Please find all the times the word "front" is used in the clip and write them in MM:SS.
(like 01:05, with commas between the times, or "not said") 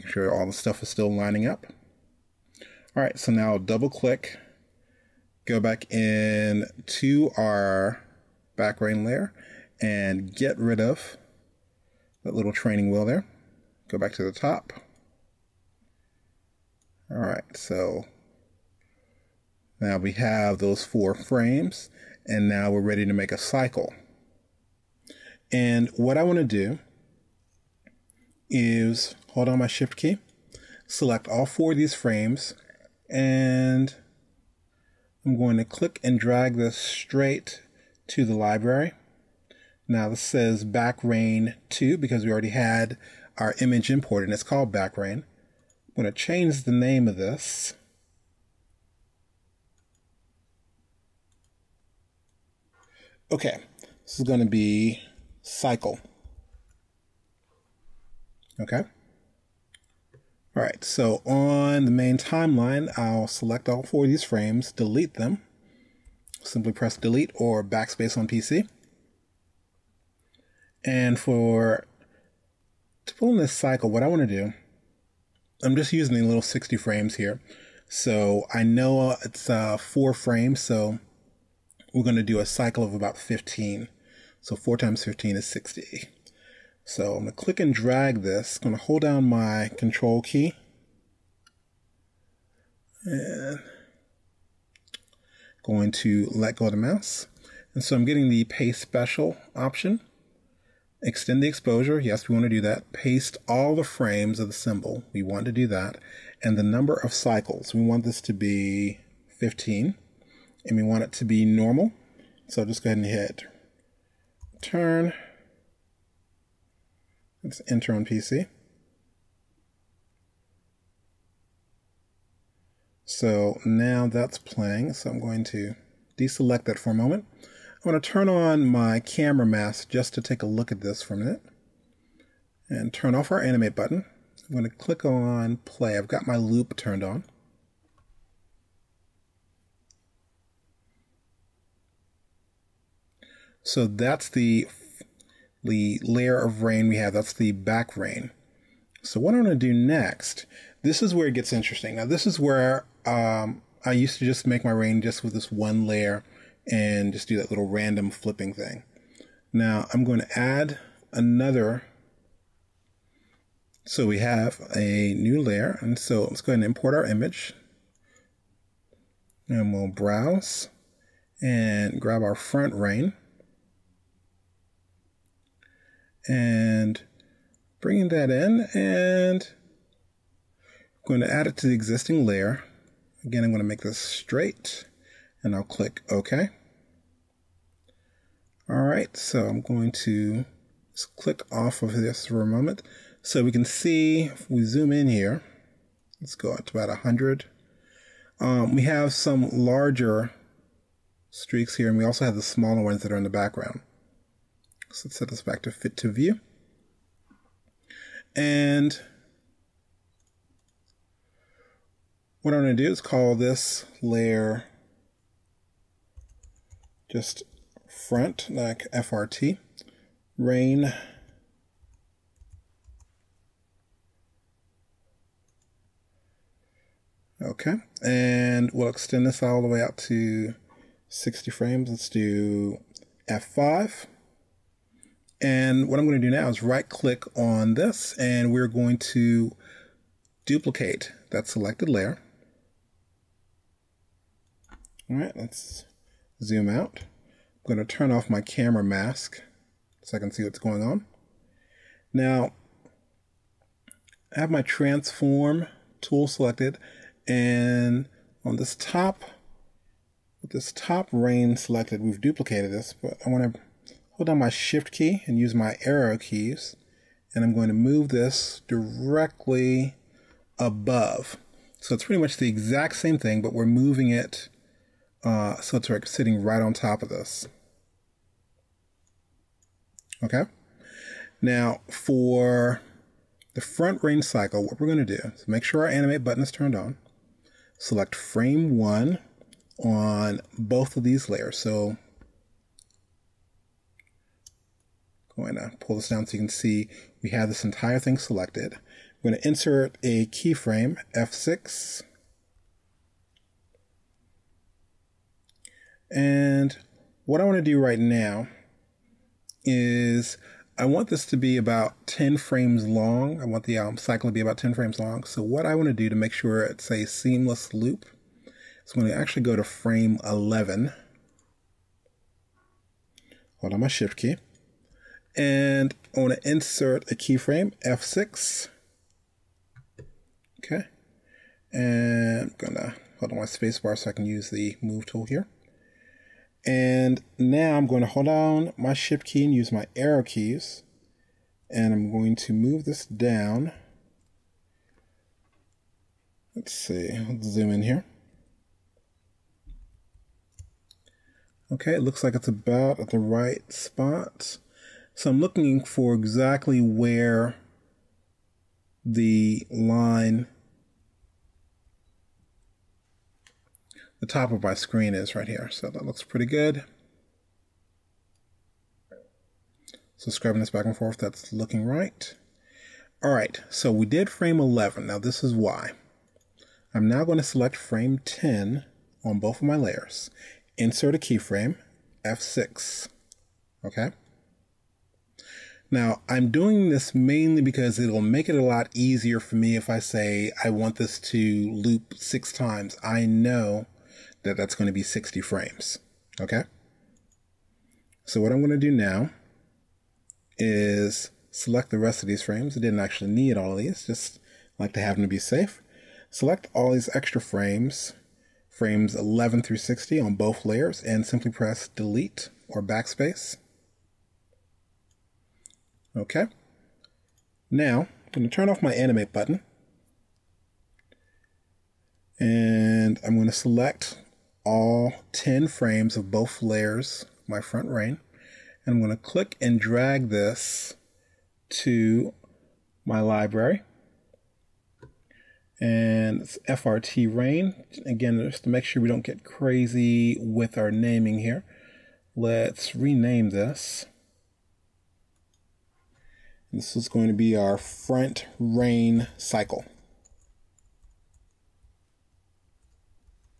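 02:52, 03:37, 04:43, 07:07, 07:27.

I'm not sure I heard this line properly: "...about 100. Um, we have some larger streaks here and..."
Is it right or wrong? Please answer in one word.
right.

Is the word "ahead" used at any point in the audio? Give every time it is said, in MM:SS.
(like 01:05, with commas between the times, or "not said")
01:52, 02:46.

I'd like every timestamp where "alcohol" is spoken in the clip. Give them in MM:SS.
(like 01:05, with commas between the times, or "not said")
not said.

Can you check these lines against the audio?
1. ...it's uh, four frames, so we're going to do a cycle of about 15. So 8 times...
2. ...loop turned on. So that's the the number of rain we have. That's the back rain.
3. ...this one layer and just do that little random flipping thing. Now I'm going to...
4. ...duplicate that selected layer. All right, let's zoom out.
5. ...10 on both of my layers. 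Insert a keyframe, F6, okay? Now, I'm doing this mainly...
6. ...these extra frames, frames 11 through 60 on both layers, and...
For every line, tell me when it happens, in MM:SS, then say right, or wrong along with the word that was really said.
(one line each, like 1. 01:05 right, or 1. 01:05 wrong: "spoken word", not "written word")
1. 01:19 wrong: "4", not "8"
2. 02:16 wrong: "layer", not "number"
3. 02:35 right
4. 04:00 right
5. 06:18 right
6. 06:46 right.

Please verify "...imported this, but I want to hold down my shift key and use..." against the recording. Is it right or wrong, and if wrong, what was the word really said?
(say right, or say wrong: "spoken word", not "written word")
wrong: "duplicated", not "imported".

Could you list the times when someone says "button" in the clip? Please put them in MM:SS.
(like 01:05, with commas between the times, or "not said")
02:13, 04:46, 06:59.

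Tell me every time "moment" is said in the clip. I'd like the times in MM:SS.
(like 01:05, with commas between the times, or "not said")
02:06, 03:12.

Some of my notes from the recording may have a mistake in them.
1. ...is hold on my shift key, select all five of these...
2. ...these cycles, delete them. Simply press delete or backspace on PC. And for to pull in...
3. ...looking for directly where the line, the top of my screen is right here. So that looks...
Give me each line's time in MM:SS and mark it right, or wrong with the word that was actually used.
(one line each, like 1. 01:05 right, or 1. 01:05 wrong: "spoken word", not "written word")
1. 00:28 wrong: "four", not "five"
2. 01:04 wrong: "frames", not "cycles"
3. 05:55 wrong: "exactly", not "directly".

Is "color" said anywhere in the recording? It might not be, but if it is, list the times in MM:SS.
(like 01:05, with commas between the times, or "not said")
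not said.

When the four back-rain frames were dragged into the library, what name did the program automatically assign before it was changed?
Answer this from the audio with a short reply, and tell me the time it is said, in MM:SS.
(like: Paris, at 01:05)
Backrain 2, at 00:40.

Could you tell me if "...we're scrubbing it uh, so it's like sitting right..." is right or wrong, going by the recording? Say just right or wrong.
wrong.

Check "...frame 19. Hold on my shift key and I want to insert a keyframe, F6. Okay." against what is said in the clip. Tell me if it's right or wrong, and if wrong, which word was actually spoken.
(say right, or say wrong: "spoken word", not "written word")
wrong: "11", not "19".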